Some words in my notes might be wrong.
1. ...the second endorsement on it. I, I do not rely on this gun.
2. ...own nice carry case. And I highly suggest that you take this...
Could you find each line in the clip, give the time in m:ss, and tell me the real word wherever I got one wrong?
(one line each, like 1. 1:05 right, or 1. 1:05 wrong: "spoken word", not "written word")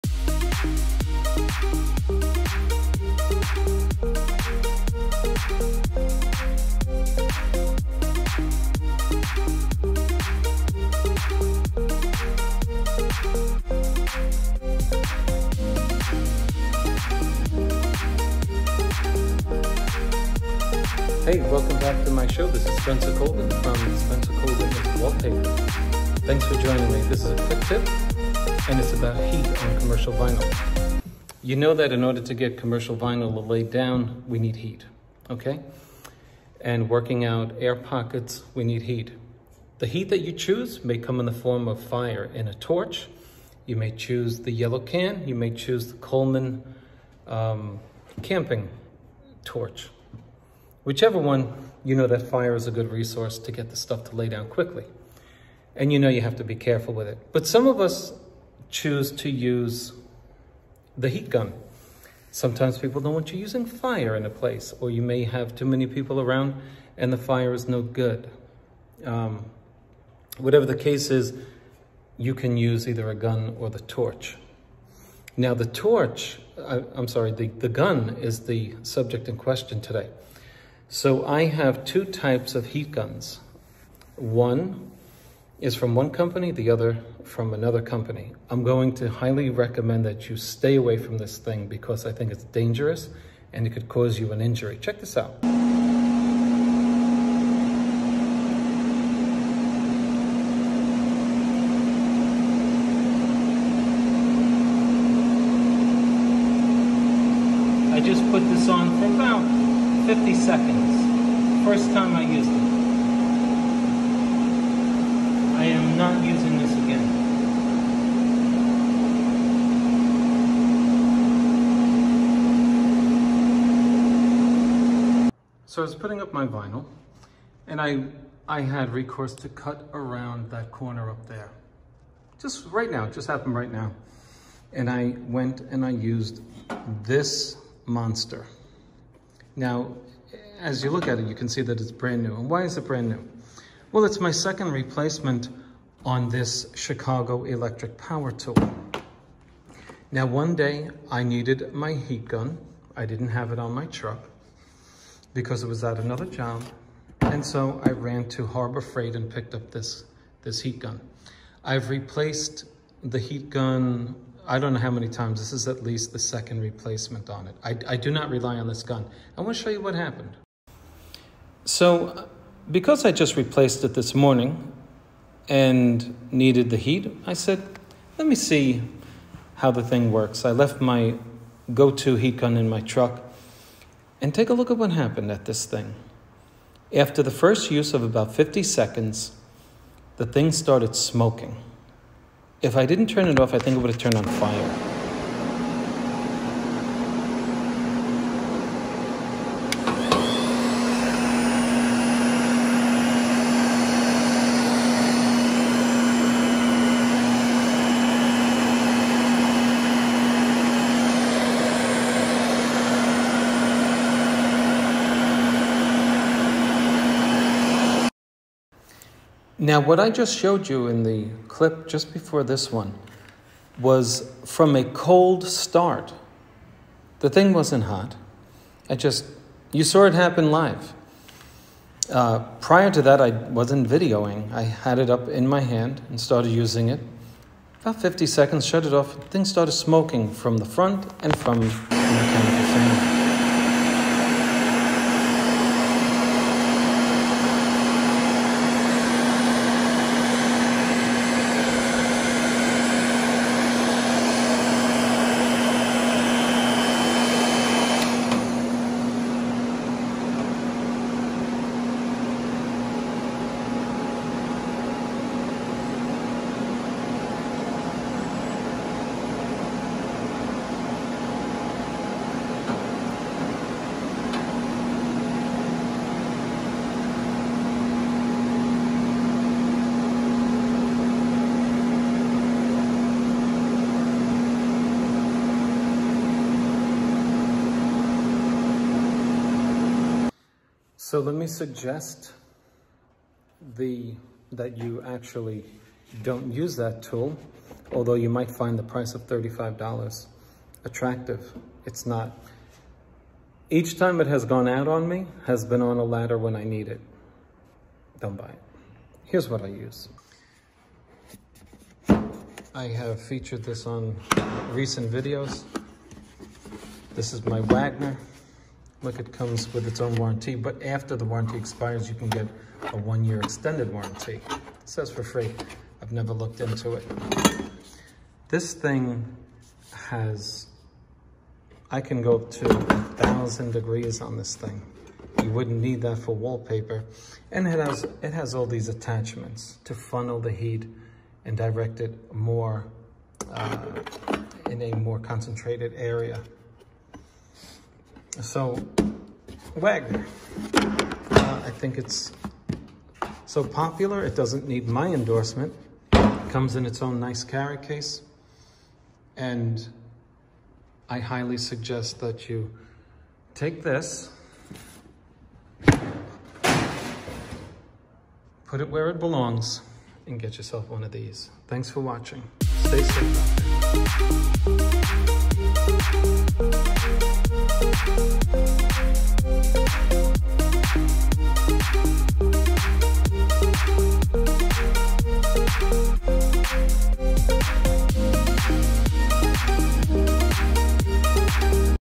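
1. 2:46 wrong: "replacement", not "endorsement"
2. 5:57 right.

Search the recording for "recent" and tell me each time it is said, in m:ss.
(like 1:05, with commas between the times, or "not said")
5:14.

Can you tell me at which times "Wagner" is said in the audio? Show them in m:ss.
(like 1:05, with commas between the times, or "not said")
5:17, 5:49.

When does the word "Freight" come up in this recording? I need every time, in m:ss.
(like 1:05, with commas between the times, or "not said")
2:38.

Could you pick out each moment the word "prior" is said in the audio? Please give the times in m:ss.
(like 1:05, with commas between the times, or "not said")
3:52.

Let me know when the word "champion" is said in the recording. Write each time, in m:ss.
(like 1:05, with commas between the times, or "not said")
not said.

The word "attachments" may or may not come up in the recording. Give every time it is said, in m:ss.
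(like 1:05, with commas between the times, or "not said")
5:38.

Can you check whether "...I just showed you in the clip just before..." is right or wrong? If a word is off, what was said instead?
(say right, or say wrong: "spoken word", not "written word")
right.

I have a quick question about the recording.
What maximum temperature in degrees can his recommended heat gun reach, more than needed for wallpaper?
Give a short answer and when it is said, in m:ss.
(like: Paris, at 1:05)
1,000 degrees, at 5:32.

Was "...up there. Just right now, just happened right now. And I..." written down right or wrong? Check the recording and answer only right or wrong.
right.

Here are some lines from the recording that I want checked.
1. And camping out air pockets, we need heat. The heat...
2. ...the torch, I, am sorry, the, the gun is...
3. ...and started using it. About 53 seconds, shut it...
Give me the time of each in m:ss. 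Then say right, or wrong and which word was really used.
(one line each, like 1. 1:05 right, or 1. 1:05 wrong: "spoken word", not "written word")
1. 0:36 wrong: "working", not "camping"
2. 1:15 right
3. 3:56 wrong: "50", not "53".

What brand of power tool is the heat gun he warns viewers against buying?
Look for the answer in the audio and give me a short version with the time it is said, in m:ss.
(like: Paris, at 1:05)
Chicago Electric, at 2:26.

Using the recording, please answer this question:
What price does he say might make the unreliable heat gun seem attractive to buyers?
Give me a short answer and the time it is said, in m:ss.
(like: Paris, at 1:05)
$35, at 4:59.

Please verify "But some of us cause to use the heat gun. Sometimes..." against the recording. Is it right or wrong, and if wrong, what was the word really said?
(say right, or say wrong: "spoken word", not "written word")
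wrong: "choose", not "cause".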